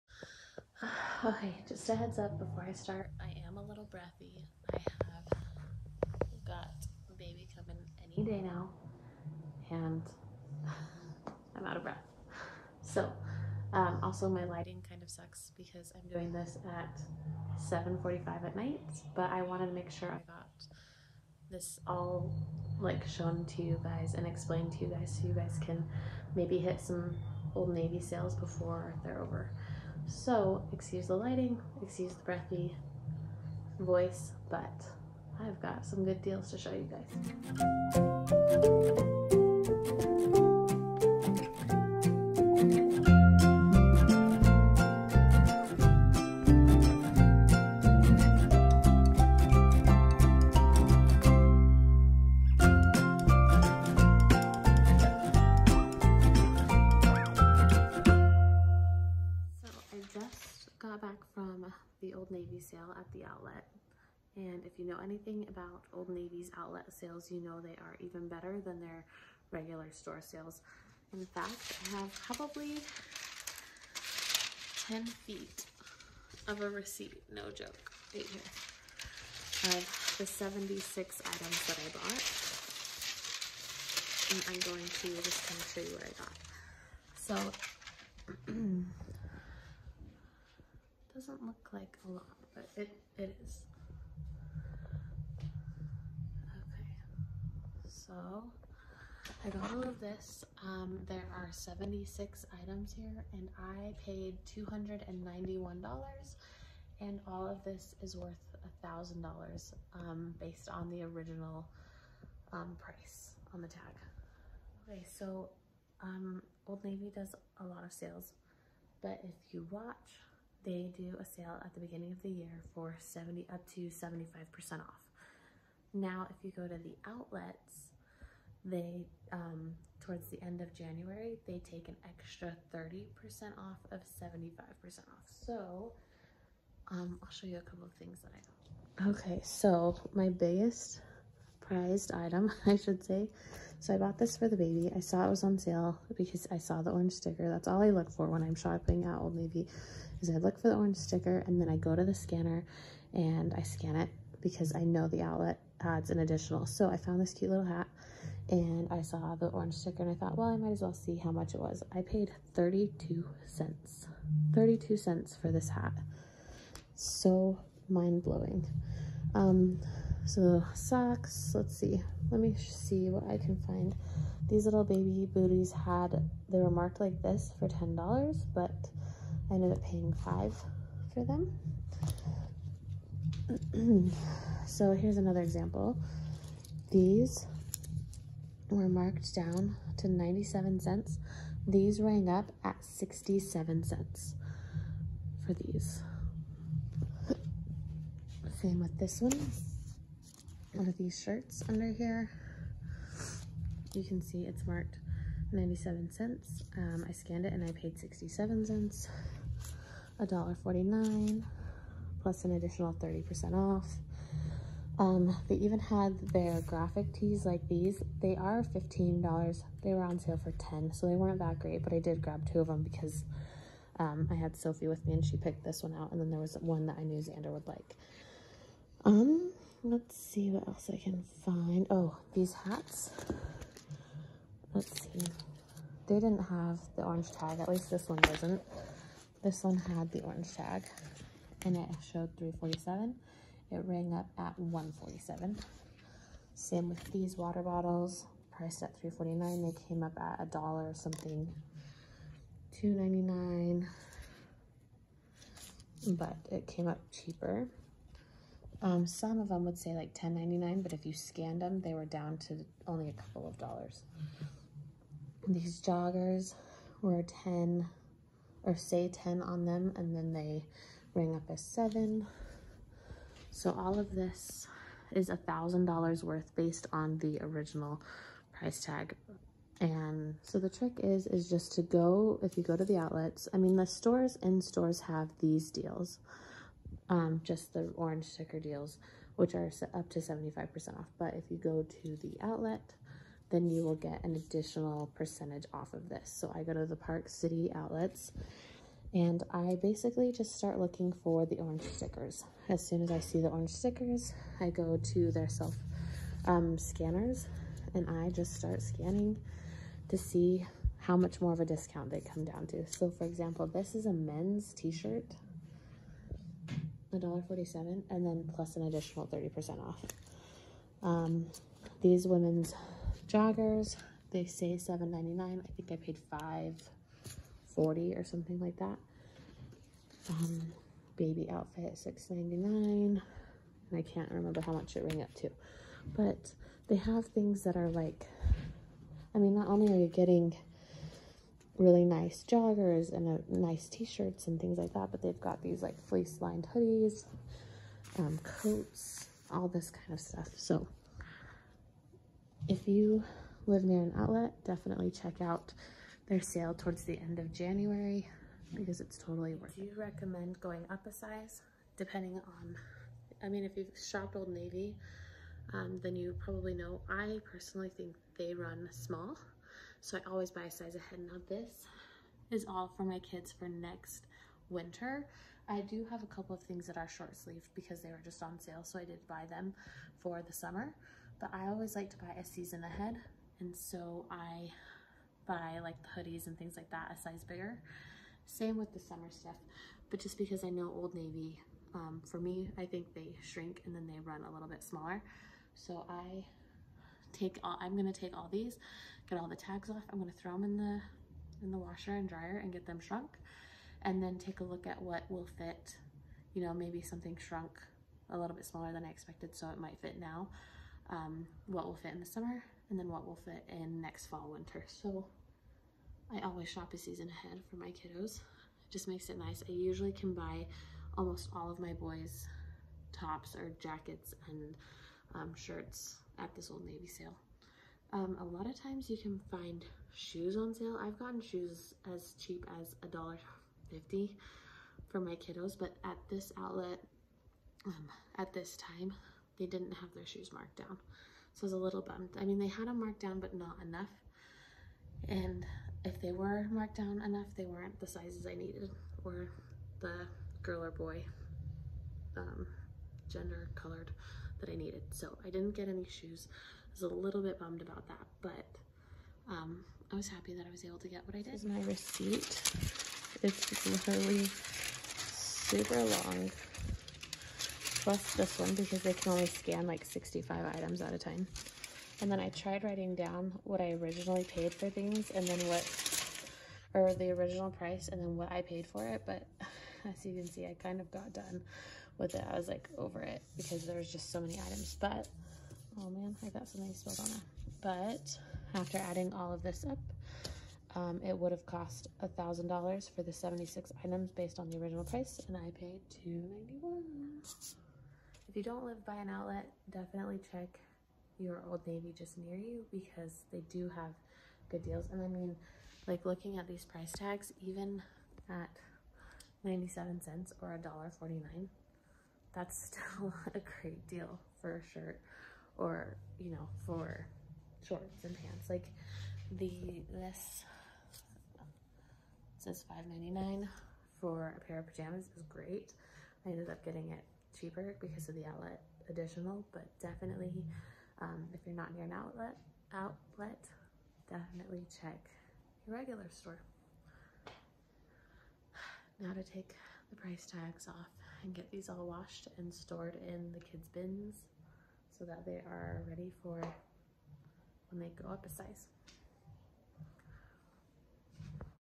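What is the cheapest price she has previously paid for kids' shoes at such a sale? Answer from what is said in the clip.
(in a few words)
$1.50.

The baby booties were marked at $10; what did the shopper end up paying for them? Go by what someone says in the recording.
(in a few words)
$5.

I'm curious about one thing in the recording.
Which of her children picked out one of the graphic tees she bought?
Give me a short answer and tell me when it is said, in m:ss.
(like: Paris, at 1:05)
Sophie, at 3:44.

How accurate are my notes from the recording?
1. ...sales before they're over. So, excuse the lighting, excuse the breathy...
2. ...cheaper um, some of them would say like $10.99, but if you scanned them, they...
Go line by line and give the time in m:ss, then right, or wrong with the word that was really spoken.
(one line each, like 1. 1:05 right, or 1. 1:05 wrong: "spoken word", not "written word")
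1. 0:28 right
2. 4:17 right.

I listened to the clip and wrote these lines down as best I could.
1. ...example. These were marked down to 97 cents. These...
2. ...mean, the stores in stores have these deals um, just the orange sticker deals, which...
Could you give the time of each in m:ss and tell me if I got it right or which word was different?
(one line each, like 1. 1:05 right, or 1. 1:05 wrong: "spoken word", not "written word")
1. 3:05 right
2. 4:43 right.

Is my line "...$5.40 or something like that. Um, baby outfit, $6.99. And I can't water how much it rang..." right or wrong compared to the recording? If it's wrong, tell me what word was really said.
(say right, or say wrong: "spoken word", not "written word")
wrong: "remember", not "water".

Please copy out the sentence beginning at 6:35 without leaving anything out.
So I take all, I'm gonna take all these, get all the tags off.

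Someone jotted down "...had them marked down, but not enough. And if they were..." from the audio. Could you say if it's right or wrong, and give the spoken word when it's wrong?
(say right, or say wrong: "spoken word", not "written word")
right.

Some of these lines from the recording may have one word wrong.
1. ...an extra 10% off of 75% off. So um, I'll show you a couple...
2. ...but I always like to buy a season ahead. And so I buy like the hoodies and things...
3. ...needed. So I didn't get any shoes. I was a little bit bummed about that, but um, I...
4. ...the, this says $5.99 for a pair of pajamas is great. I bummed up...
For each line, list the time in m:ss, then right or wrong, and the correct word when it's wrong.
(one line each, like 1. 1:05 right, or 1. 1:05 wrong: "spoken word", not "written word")
1. 2:11 wrong: "30", not "10"
2. 6:21 right
3. 7:34 right
4. 8:39 wrong: "ended", not "bummed".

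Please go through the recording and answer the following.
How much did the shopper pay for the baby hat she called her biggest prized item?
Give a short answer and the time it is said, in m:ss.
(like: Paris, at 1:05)
32 cents, at 2:41.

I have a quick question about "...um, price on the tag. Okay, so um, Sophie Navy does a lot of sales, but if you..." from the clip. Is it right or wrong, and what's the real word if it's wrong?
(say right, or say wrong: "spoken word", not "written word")
wrong: "Old", not "Sophie".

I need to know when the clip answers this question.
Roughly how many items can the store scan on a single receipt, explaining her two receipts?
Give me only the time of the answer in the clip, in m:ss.
7:50.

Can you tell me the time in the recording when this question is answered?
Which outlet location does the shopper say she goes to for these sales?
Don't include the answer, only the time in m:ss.
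4:56.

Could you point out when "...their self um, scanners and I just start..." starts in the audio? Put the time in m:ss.
5:05.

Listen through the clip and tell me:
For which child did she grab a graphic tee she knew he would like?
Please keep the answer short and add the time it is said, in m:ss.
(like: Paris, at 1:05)
Xander, at 3:47.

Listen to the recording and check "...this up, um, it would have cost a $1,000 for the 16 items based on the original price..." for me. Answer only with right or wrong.
wrong.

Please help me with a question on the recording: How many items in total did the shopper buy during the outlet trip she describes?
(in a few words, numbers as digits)
76.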